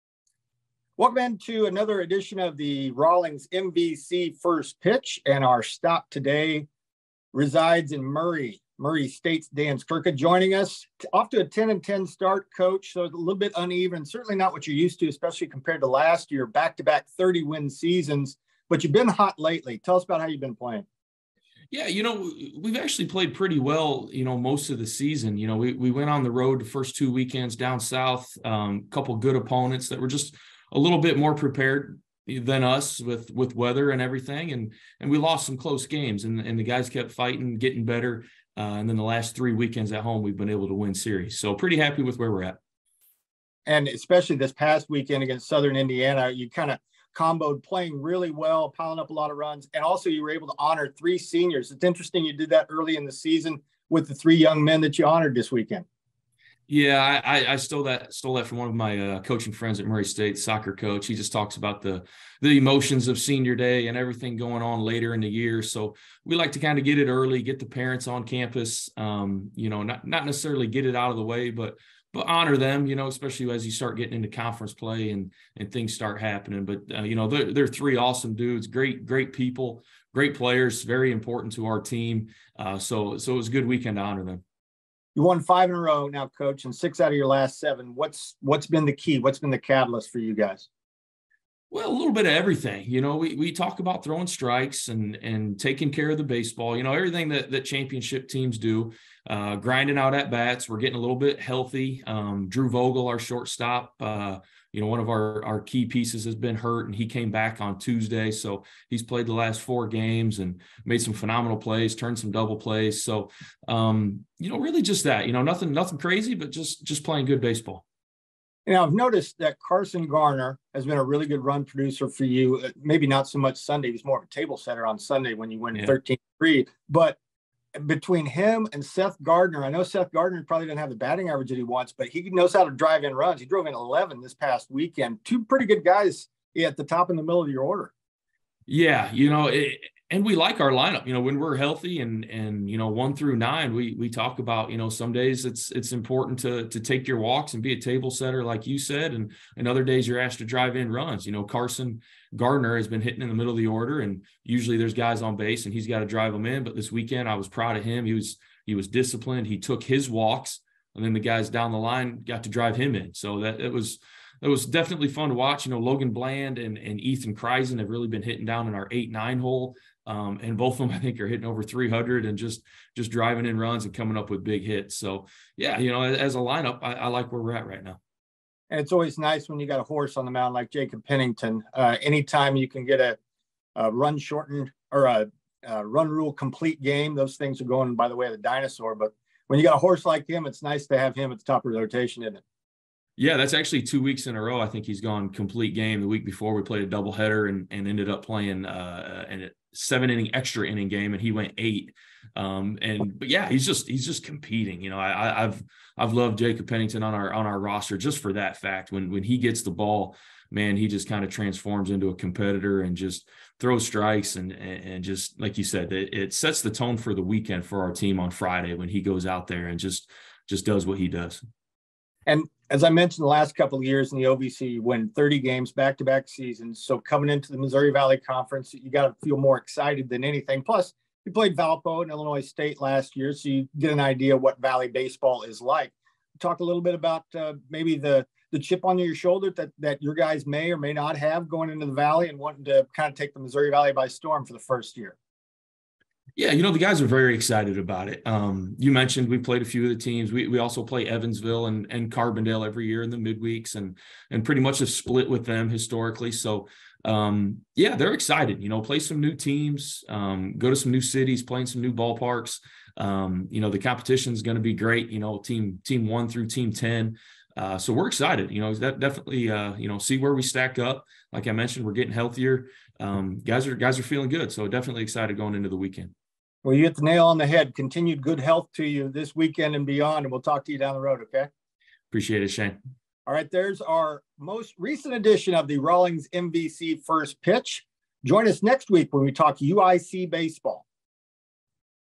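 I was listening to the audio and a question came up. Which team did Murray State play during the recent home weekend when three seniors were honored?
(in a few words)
Southern Indiana.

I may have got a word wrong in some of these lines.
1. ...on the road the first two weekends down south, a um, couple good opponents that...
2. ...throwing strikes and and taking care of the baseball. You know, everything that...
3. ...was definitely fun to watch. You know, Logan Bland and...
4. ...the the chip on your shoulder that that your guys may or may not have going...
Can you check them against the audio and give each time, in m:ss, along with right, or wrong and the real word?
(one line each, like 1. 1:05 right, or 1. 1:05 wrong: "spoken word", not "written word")
1. 0:26 right
2. 1:34 right
3. 2:44 right
4. 3:57 right.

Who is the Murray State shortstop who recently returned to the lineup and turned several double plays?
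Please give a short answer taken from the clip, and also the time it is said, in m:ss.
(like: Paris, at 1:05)
Drew Vogel, at 1:42.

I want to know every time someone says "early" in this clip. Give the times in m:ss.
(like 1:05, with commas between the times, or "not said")
0:52, 1:07.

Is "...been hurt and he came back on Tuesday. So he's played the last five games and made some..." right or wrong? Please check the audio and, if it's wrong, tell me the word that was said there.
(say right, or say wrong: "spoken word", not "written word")
wrong: "four", not "five".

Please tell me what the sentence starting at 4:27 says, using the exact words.
Uh, so we're excited, you know, that definitely, uh, you know, see where we stack up.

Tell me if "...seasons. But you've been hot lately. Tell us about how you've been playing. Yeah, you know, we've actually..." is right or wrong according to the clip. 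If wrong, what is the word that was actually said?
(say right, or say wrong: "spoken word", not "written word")
right.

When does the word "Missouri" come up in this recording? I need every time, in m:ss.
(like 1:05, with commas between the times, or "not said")
3:47, 4:03.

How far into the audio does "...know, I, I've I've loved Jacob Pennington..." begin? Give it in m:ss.
3:24.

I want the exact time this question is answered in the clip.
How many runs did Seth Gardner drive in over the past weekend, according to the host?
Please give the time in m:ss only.
2:13.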